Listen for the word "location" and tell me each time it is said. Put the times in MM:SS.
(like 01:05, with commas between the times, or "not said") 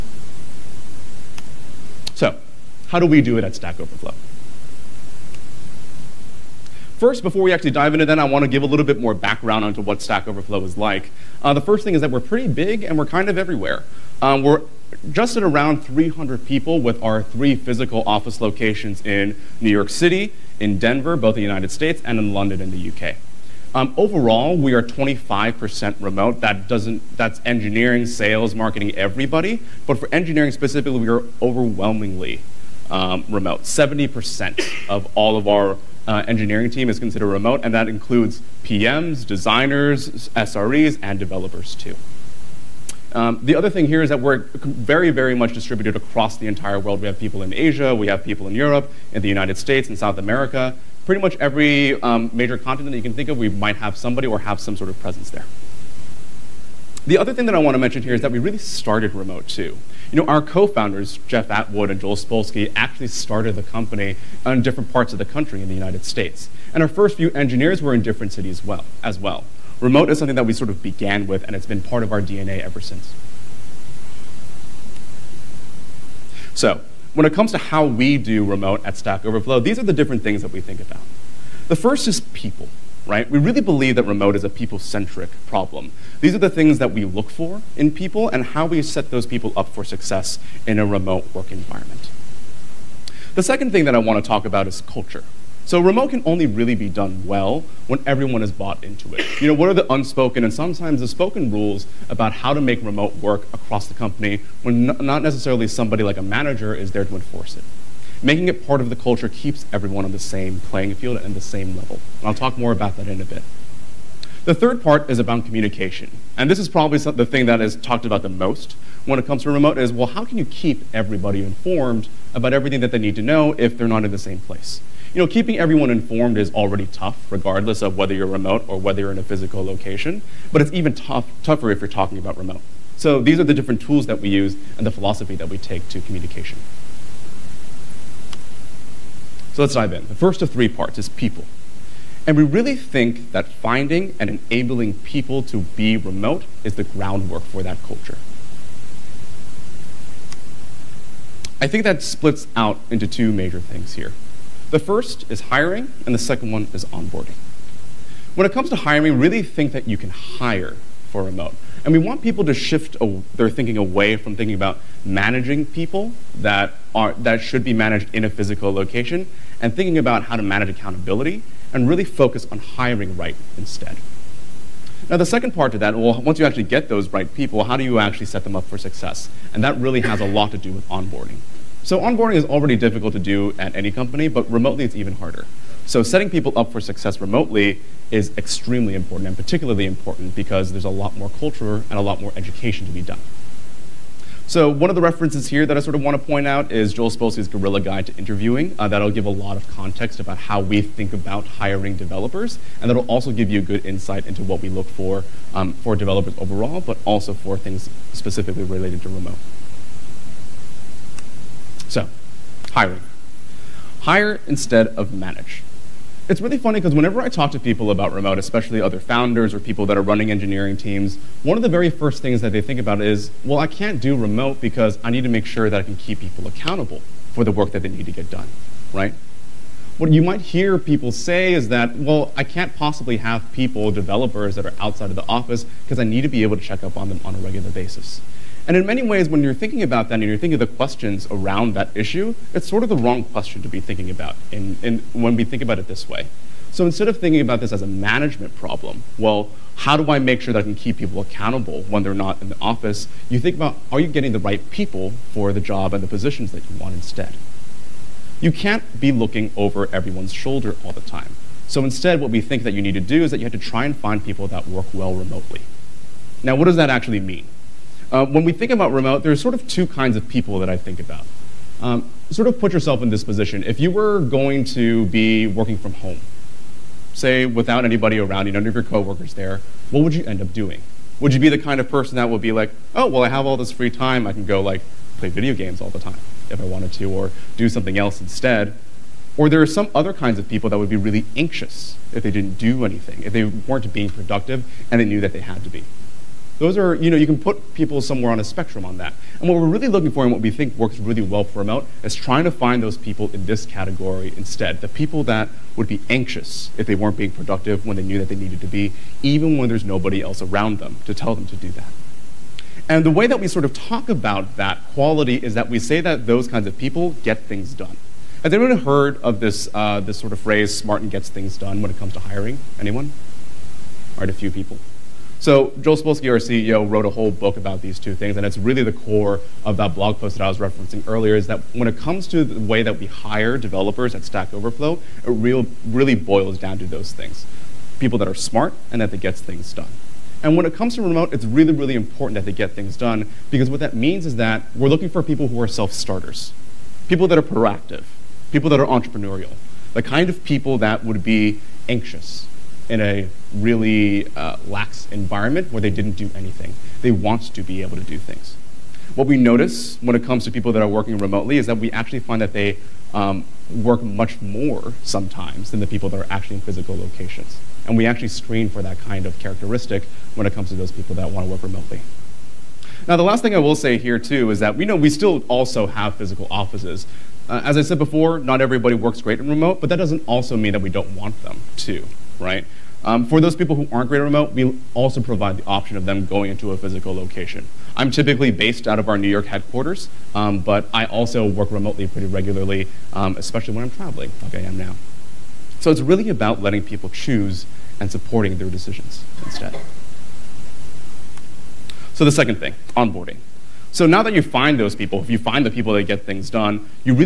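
00:18, 02:09, 02:48, 06:06, 06:27.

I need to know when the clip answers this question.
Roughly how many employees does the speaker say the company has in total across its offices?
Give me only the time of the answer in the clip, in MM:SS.
00:15.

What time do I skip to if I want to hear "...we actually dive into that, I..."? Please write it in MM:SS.
00:07.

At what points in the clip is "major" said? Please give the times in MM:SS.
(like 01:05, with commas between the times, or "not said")
00:52, 02:33.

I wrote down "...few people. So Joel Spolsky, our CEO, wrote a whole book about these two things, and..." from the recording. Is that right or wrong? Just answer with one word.
right.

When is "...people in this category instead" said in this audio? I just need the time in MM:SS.
05:02.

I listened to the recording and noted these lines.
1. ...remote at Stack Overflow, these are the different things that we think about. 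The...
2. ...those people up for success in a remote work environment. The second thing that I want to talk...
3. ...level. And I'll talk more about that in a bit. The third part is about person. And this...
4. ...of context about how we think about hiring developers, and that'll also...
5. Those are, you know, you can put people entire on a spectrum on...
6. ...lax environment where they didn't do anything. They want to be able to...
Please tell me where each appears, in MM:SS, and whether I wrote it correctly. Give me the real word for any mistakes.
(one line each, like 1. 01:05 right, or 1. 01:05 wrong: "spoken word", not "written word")
1. 01:18 right
2. 01:29 right
3. 01:51 wrong: "communication", not "person"
4. 03:19 right
5. 04:56 wrong: "somewhere", not "entire"
6. 05:54 right.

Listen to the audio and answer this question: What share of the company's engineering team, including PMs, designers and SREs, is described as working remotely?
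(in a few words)
70%.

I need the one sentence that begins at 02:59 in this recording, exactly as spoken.
And that really has a lot to do with onboarding.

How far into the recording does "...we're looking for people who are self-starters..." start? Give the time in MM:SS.
05:44.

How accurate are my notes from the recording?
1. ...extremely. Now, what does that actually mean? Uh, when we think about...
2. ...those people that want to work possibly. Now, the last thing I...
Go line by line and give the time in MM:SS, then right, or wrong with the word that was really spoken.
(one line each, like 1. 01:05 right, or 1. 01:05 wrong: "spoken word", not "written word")
1. 04:25 wrong: "remotely", not "extremely"
2. 06:10 wrong: "remotely", not "possibly".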